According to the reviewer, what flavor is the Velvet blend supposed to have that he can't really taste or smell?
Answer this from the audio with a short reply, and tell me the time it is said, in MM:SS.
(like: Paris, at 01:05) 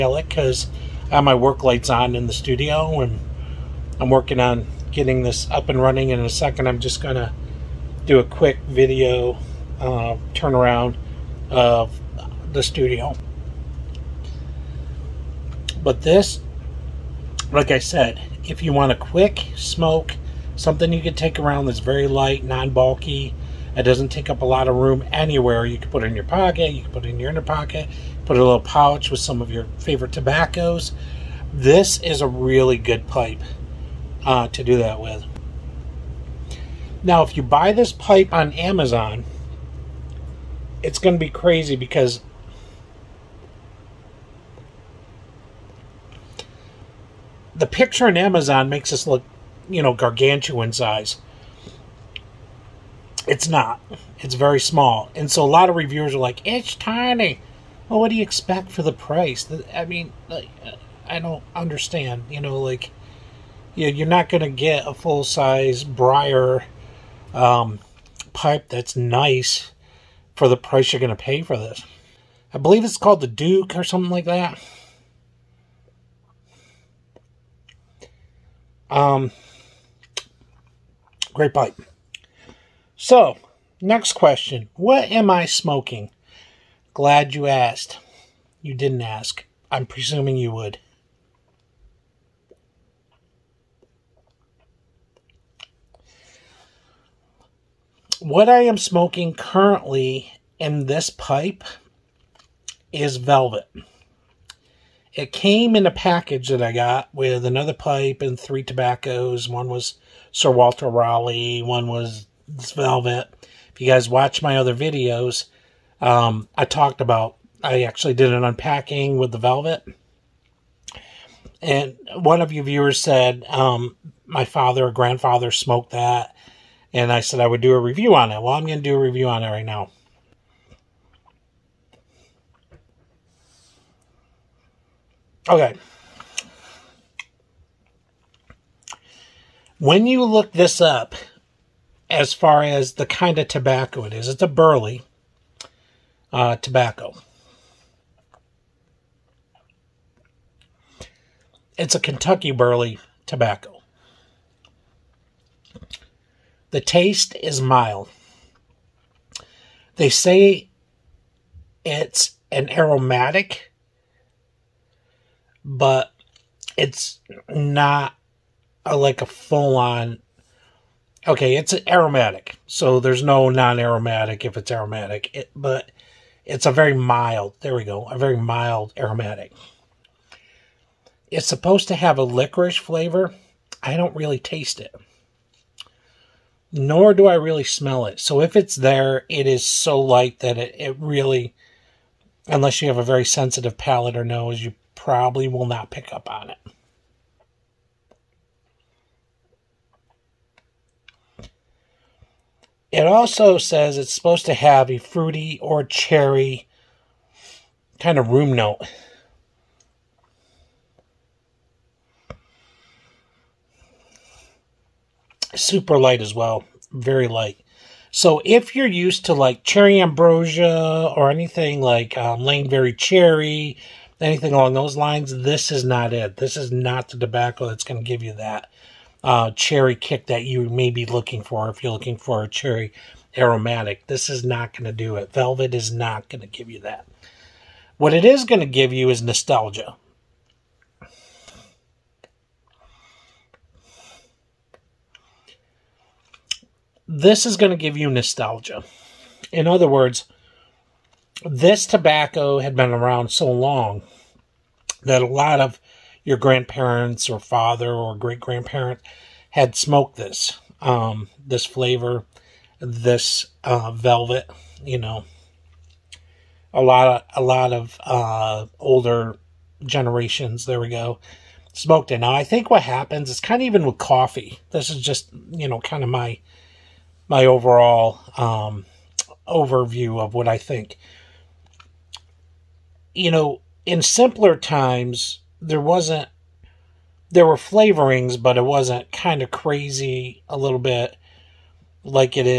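Licorice, at 03:02.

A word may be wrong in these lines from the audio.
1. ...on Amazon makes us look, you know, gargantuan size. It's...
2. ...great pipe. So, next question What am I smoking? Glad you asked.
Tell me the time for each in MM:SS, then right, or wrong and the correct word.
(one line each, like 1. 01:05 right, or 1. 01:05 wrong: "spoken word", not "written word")
1. 00:48 right
2. 01:21 right.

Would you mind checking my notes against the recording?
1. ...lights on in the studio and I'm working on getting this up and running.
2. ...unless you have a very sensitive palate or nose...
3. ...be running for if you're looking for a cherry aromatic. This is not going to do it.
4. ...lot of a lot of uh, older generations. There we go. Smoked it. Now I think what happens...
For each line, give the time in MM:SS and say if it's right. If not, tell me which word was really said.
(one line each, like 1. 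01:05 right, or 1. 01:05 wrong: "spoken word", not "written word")
1. 00:01 right
2. 03:12 right
3. 03:50 wrong: "looking", not "running"
4. 04:26 right.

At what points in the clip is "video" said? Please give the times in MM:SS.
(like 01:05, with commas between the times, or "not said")
00:08, 01:54.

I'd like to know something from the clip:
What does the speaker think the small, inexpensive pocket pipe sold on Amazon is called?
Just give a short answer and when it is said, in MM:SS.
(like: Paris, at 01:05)
The Duke, at 01:13.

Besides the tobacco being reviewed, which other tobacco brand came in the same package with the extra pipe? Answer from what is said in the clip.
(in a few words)
Sir Walter Raleigh.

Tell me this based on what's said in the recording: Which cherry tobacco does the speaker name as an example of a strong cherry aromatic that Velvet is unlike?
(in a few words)
Cherry Ambrosia.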